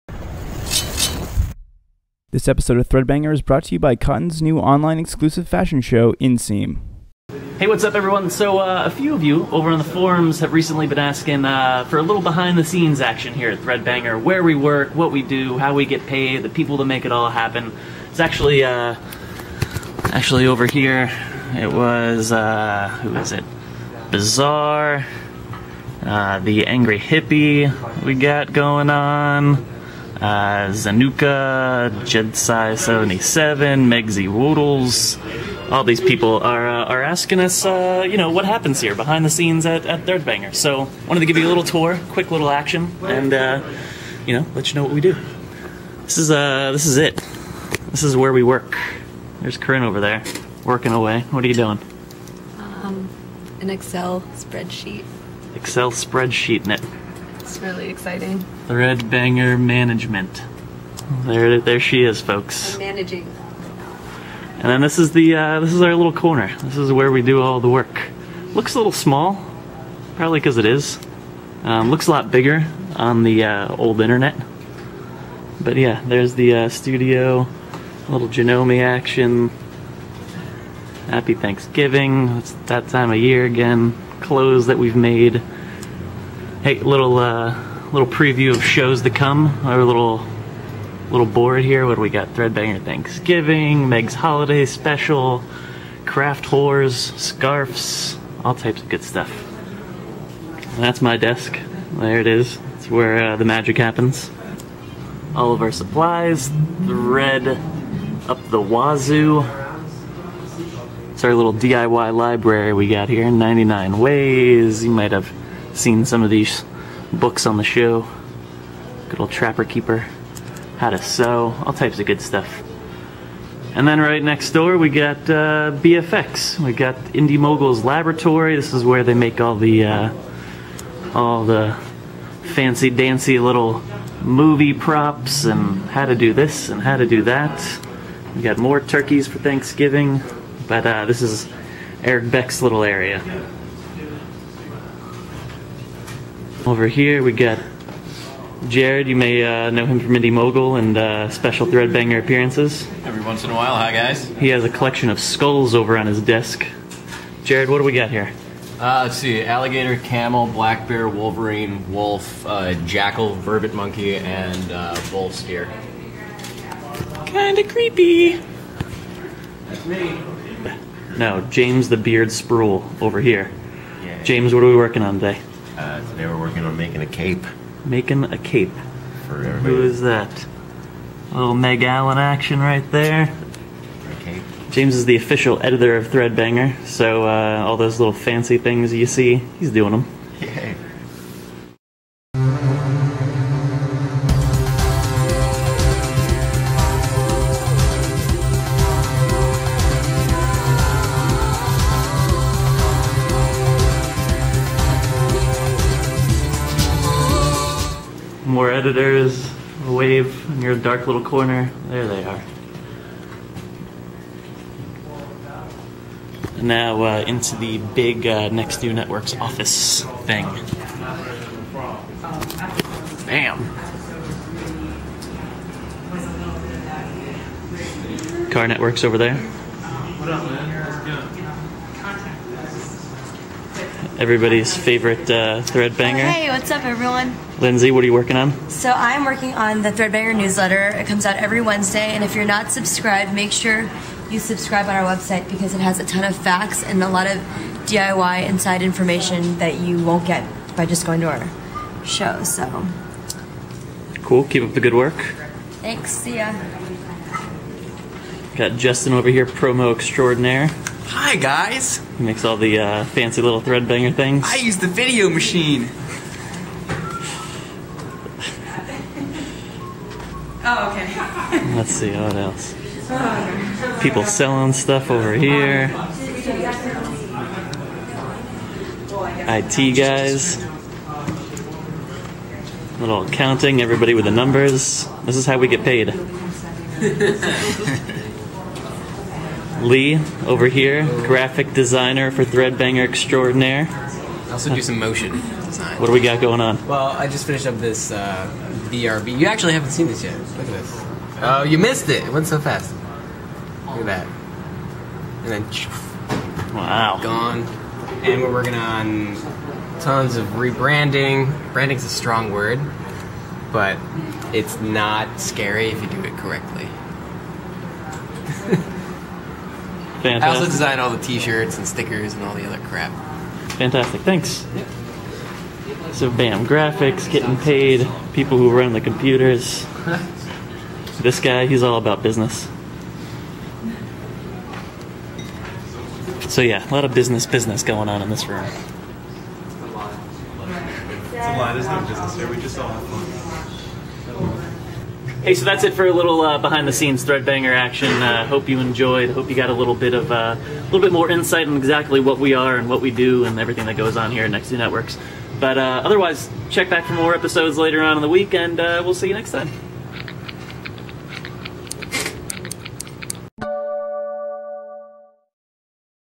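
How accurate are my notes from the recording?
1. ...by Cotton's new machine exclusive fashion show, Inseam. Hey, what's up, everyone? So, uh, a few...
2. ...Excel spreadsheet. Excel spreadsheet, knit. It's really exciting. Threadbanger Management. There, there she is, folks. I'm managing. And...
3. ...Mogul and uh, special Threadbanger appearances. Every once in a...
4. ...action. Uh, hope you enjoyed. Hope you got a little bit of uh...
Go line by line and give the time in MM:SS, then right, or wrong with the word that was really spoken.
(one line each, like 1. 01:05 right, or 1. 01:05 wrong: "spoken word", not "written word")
1. 00:03 wrong: "online", not "machine"
2. 00:53 right
3. 02:30 right
4. 05:47 right.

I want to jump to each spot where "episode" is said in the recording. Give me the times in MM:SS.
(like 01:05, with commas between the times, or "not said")
00:02, 05:57.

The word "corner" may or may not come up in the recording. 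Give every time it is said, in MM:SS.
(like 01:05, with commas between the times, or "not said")
01:06, 03:31.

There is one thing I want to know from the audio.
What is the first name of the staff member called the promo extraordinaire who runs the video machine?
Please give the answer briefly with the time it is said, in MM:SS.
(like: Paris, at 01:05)
Justin, at 04:18.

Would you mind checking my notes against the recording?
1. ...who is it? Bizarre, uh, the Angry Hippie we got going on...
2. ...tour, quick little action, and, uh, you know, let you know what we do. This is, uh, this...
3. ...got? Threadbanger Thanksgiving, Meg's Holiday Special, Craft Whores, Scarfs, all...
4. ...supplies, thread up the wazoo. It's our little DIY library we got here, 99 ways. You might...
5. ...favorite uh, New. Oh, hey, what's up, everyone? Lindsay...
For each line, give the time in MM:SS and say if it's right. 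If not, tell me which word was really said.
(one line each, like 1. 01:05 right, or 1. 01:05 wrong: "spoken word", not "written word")
1. 00:23 right
2. 00:41 right
3. 01:32 right
4. 01:45 right
5. 03:54 wrong: "Threadbanger", not "New".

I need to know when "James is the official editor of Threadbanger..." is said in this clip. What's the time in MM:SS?
03:04.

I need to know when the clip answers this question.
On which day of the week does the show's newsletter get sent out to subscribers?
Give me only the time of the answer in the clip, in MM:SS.
04:01.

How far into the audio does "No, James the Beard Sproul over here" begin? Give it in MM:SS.
02:51.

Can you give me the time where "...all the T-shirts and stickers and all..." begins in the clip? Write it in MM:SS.
05:20.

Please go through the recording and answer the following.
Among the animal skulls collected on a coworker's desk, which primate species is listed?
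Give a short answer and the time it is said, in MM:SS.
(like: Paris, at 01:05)
vervet monkey, at 02:43.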